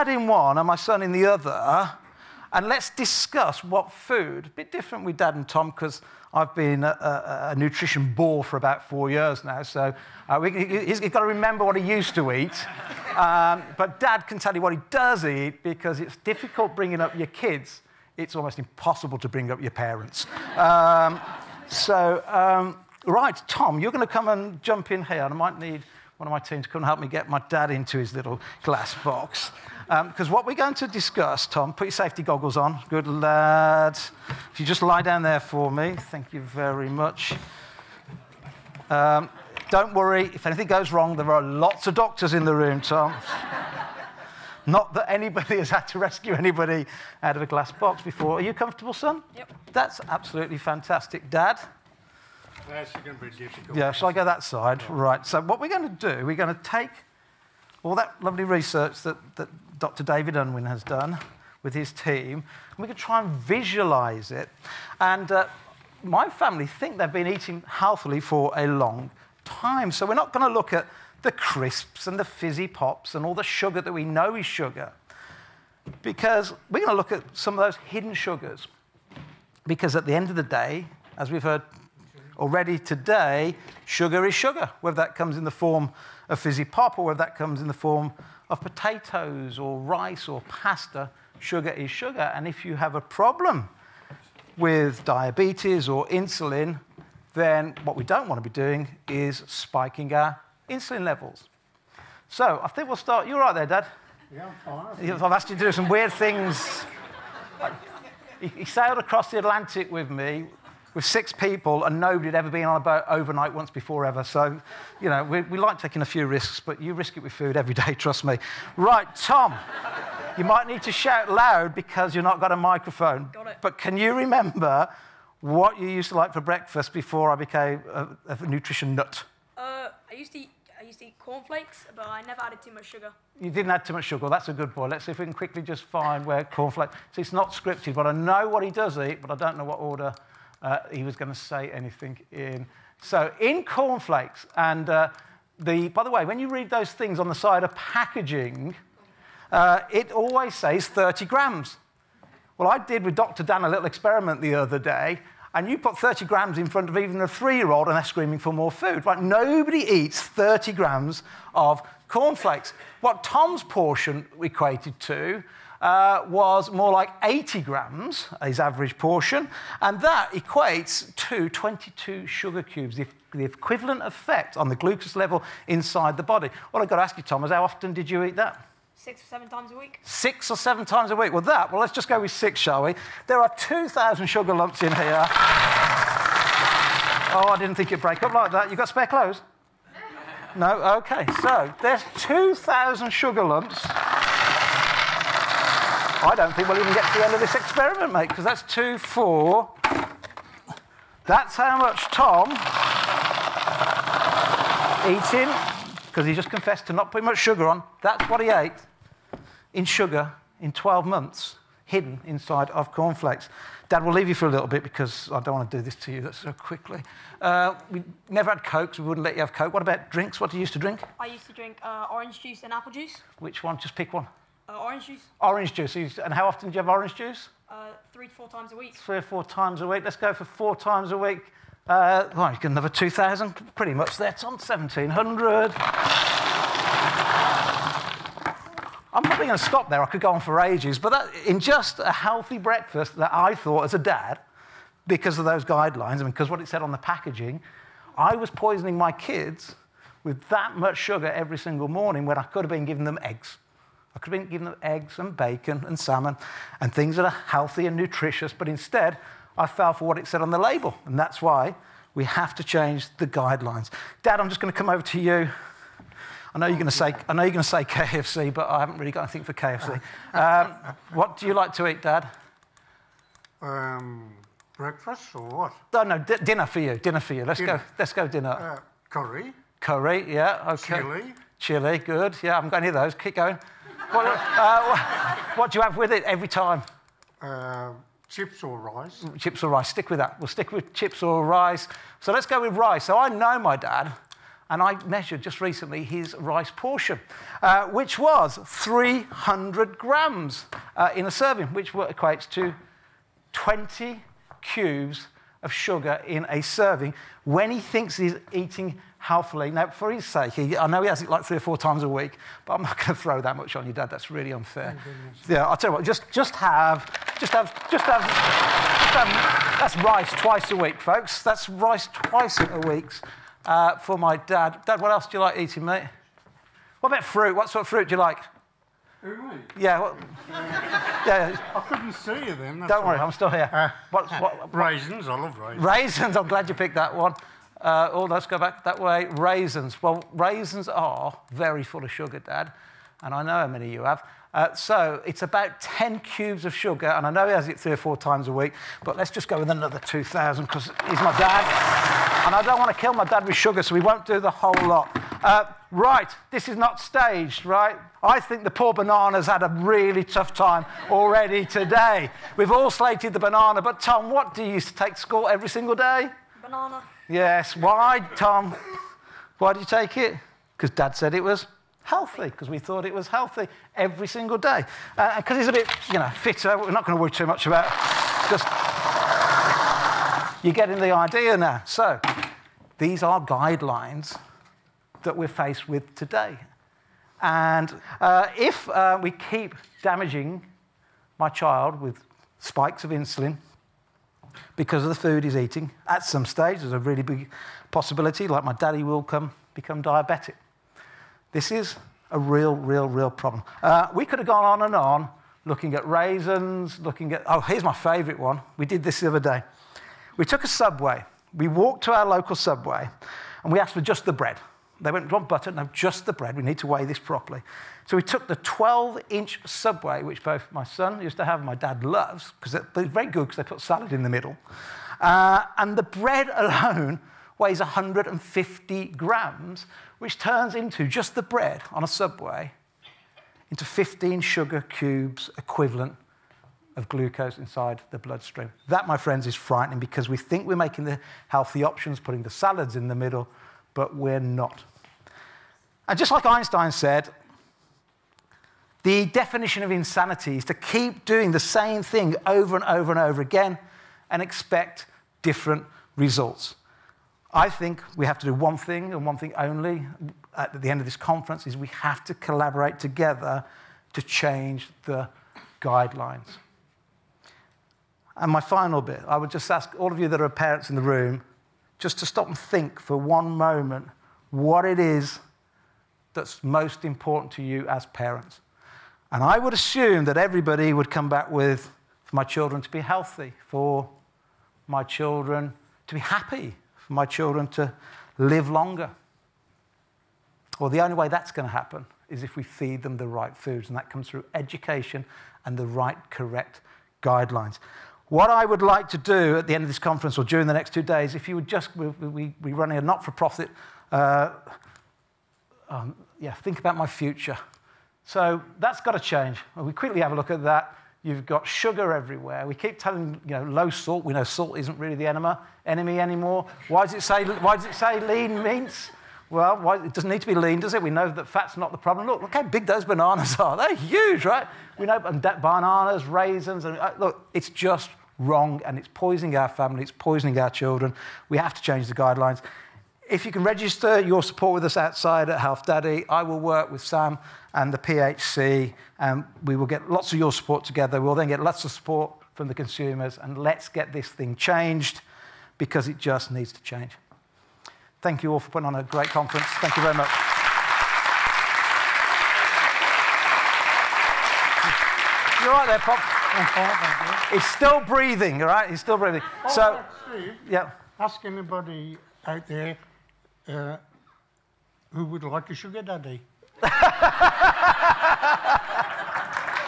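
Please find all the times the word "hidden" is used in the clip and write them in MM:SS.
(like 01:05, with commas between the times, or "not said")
01:17, 03:31.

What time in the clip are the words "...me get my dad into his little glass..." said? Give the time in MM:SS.
00:26.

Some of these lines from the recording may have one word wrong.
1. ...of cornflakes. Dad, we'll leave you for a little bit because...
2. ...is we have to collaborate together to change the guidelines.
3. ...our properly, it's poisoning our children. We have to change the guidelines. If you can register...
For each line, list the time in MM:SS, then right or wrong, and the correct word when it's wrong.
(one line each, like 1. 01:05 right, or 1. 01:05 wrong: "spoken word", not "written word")
1. 03:32 right
2. 07:41 right
3. 08:49 wrong: "family", not "properly".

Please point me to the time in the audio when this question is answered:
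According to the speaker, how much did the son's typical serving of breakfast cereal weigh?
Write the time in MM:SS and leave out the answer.
02:47.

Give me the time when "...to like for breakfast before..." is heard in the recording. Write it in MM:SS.
02:06.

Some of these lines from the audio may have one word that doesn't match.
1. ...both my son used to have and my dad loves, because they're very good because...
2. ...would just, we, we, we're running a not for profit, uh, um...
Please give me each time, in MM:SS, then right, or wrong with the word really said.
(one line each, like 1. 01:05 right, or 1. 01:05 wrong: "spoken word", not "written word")
1. 07:00 right
2. 08:21 right.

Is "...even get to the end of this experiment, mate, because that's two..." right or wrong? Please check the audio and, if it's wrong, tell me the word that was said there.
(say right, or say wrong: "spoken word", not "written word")
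right.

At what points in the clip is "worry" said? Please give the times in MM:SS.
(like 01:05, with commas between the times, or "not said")
00:39, 05:33, 06:17.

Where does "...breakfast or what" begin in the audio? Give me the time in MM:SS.
04:34.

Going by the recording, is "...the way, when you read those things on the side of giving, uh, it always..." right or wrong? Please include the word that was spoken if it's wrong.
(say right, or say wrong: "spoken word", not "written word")
wrong: "packaging", not "giving".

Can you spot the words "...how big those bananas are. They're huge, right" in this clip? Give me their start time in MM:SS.
08:42.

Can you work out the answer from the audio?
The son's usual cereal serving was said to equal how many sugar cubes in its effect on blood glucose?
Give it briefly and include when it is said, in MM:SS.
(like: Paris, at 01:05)
22, at 02:51.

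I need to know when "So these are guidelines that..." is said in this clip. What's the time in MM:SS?
06:21.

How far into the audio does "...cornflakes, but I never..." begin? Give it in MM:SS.
02:11.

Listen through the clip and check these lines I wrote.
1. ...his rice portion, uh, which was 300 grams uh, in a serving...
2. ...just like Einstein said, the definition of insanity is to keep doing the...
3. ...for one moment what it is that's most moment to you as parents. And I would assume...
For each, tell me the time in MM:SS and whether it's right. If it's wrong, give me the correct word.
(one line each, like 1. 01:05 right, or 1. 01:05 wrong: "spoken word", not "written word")
1. 04:56 right
2. 07:26 right
3. 07:52 wrong: "important", not "moment".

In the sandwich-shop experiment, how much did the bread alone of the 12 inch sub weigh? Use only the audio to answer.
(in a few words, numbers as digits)
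150 grams.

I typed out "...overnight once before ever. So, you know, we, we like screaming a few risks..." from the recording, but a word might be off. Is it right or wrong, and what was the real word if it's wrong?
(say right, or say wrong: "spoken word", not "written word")
wrong: "taking", not "screaming".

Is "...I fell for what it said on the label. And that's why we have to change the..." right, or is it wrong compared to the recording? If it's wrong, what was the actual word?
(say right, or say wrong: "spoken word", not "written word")
right.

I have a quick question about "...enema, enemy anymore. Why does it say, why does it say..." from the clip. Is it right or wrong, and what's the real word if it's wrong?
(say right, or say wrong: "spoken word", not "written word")
right.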